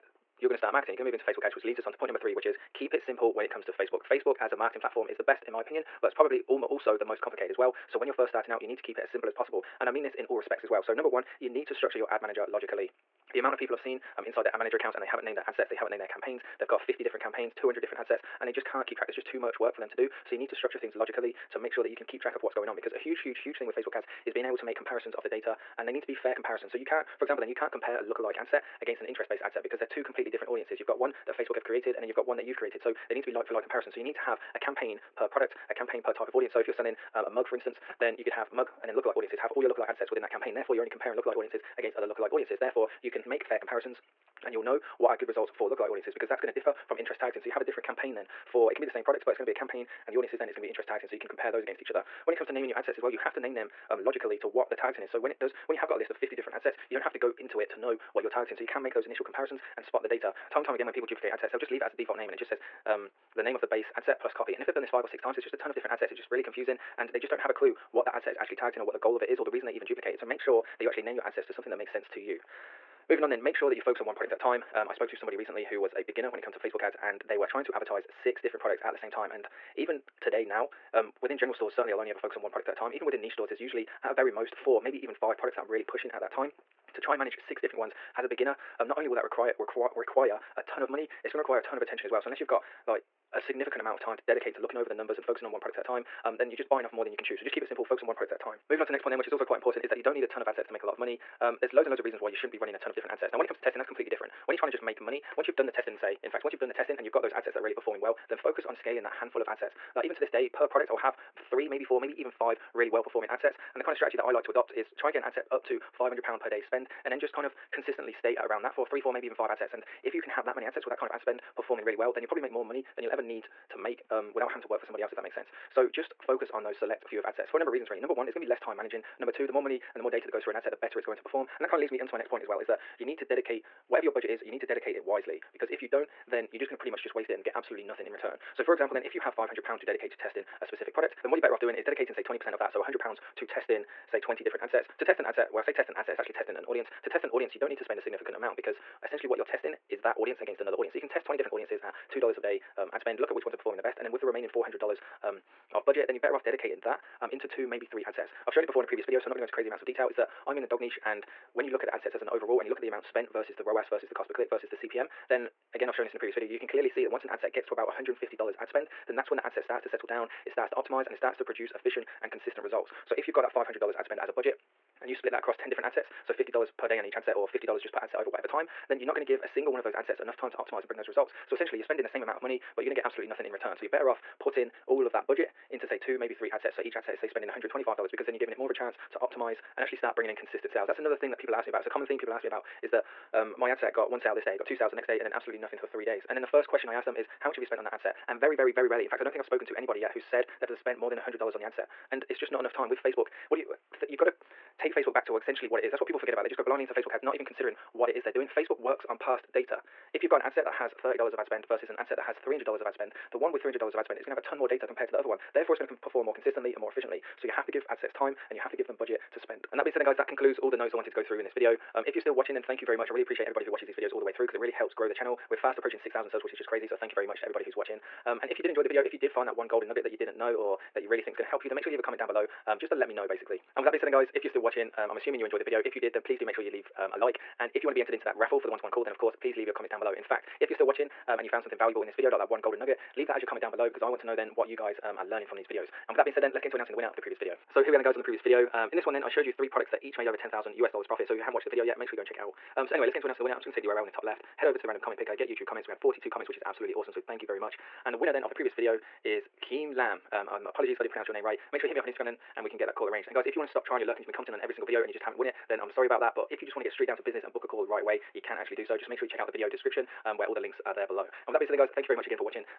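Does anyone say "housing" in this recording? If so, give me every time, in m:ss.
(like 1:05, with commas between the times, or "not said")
not said.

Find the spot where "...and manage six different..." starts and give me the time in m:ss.
1:27.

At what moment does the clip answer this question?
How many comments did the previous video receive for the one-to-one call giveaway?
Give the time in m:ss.
4:15.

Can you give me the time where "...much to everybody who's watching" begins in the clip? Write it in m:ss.
3:47.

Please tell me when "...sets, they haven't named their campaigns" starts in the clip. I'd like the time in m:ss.
0:15.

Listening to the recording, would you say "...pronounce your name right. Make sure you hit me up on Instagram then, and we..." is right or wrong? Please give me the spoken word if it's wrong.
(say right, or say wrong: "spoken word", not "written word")
right.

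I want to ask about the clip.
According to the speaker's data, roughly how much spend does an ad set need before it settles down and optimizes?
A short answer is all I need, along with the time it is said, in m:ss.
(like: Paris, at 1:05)
$150, at 2:47.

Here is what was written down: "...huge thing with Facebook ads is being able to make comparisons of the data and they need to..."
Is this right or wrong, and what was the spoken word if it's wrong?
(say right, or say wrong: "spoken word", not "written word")
right.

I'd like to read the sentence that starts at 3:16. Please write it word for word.
And then the first question I ask them is, How much have you spent on that ad set?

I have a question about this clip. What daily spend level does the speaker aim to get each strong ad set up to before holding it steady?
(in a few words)
£500 per day.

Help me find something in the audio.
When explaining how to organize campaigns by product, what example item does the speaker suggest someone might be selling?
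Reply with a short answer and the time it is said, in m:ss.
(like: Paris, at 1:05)
A mug, at 0:37.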